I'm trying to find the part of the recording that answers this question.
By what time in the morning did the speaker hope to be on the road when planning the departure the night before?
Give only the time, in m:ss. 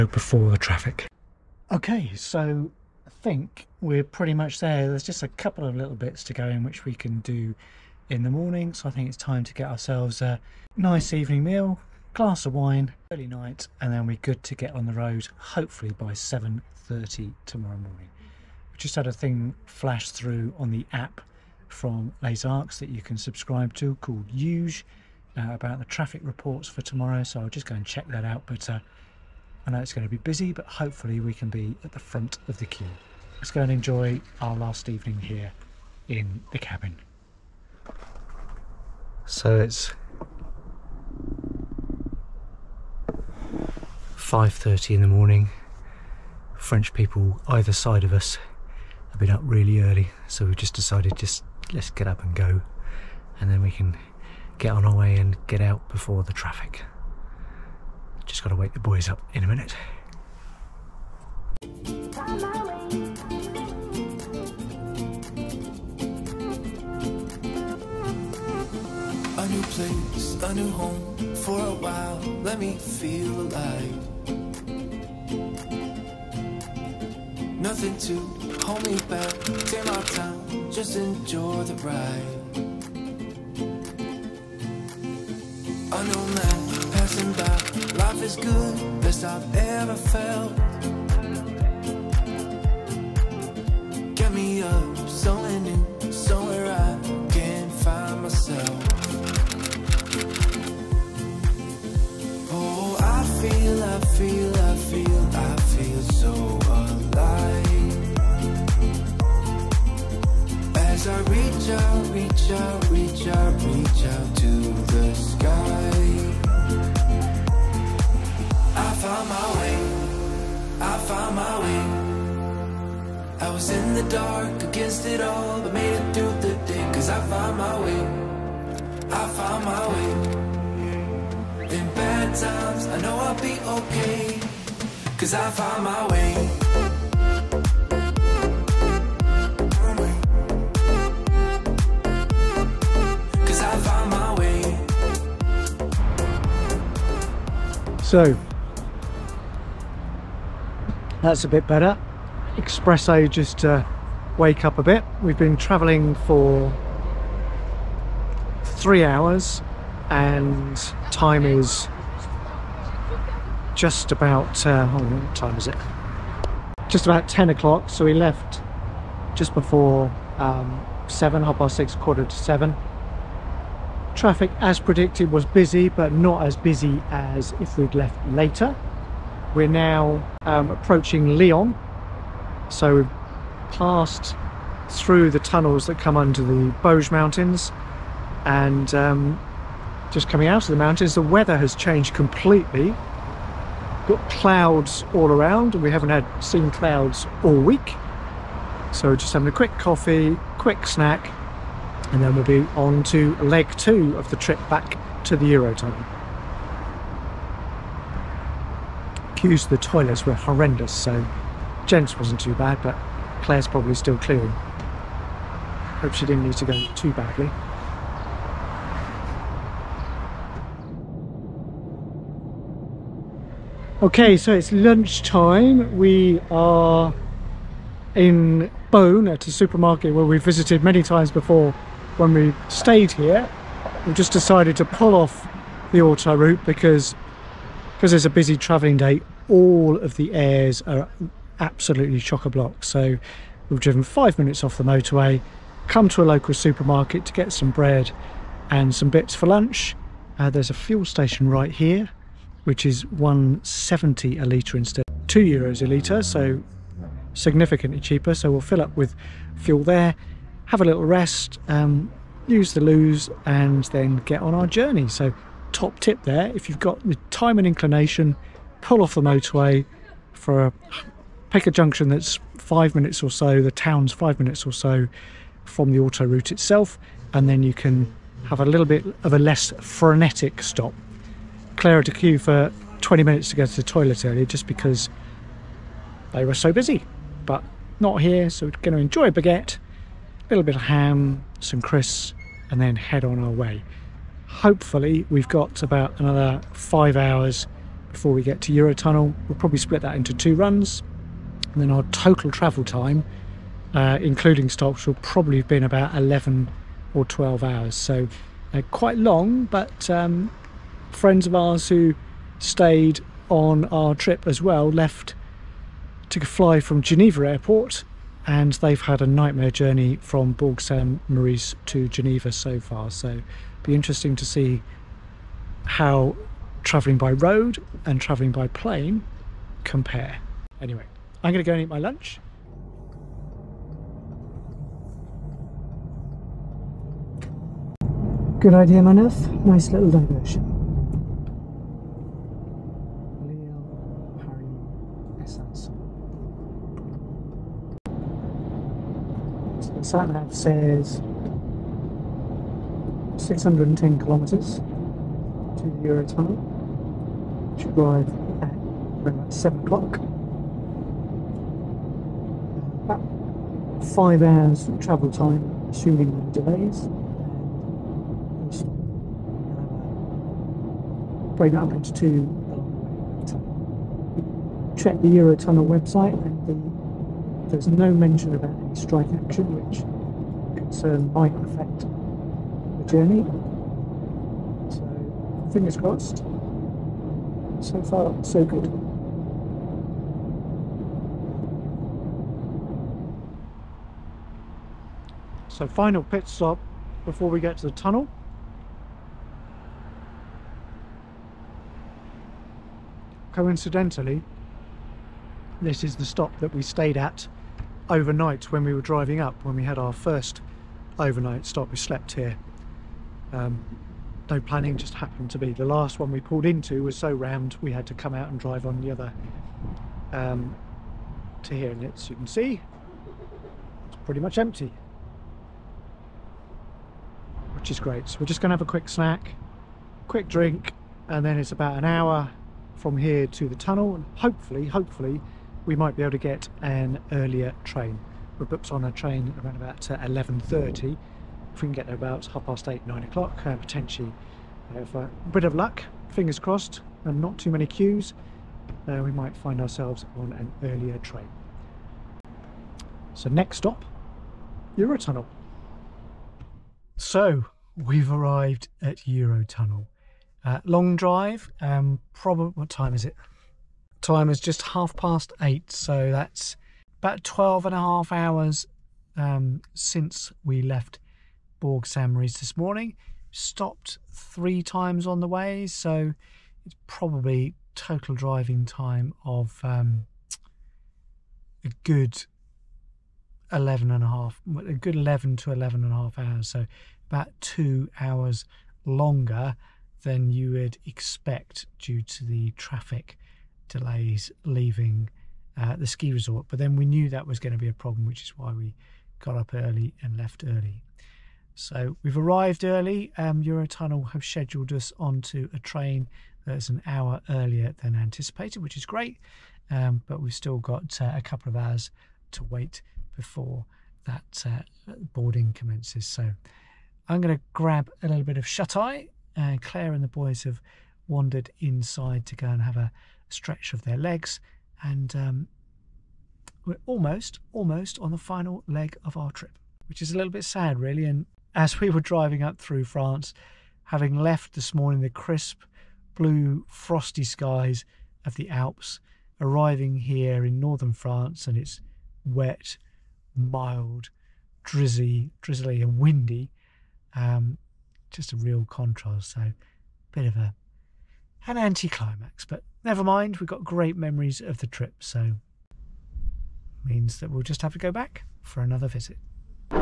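0:16.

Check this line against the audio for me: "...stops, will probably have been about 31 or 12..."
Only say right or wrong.
wrong.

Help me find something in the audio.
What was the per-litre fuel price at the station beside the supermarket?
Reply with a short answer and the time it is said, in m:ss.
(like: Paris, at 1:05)
170, at 4:13.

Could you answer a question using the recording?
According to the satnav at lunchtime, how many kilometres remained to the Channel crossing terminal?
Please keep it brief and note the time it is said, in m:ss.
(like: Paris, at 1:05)
610, at 5:53.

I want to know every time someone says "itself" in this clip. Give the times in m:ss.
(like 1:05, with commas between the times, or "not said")
4:36.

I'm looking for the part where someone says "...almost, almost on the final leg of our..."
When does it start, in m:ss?
8:47.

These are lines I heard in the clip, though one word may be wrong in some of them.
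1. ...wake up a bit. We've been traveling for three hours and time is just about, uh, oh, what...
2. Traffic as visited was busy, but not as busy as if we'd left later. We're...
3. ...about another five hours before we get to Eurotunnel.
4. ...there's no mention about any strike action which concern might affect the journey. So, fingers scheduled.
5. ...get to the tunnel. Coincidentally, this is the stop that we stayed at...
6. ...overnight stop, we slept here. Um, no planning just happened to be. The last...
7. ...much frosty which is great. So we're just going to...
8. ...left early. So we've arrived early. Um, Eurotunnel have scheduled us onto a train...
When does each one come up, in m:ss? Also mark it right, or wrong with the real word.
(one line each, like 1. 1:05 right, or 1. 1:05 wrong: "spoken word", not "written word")
1. 2:34 right
2. 2:54 wrong: "predicted", not "visited"
3. 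4:55 right
4. 6:17 wrong: "crossed", not "scheduled"
5. 6:37 right
6. 6:51 right
7. 7:04 wrong: "empty", not "frosty"
8. 8:20 right.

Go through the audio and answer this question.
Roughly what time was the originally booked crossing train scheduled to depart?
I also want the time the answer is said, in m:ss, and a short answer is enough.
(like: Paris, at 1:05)
11.30, at 7:20.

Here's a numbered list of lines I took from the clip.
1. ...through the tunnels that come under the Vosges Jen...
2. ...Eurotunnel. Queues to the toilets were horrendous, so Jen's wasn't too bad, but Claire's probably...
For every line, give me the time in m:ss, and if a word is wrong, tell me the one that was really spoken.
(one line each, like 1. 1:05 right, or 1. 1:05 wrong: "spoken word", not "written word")
1. 3:04 wrong: "Mountains", not "Jen"
2. 3:25 right.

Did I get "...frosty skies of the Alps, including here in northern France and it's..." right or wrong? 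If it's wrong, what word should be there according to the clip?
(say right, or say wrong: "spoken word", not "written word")
wrong: "arriving", not "including".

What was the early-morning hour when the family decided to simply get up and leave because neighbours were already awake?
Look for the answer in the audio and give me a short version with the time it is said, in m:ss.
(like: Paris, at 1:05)
5.30, at 0:44.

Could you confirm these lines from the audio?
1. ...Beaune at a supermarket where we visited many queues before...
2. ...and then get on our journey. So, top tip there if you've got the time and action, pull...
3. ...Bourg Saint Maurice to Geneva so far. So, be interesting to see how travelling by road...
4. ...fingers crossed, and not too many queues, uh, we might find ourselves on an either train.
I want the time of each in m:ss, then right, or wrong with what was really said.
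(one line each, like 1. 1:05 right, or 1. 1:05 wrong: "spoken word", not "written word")
1. 3:48 wrong: "times", not "queues"
2. 4:23 wrong: "inclination", not "action"
3. 5:20 right
4. 7:26 wrong: "earlier", not "either".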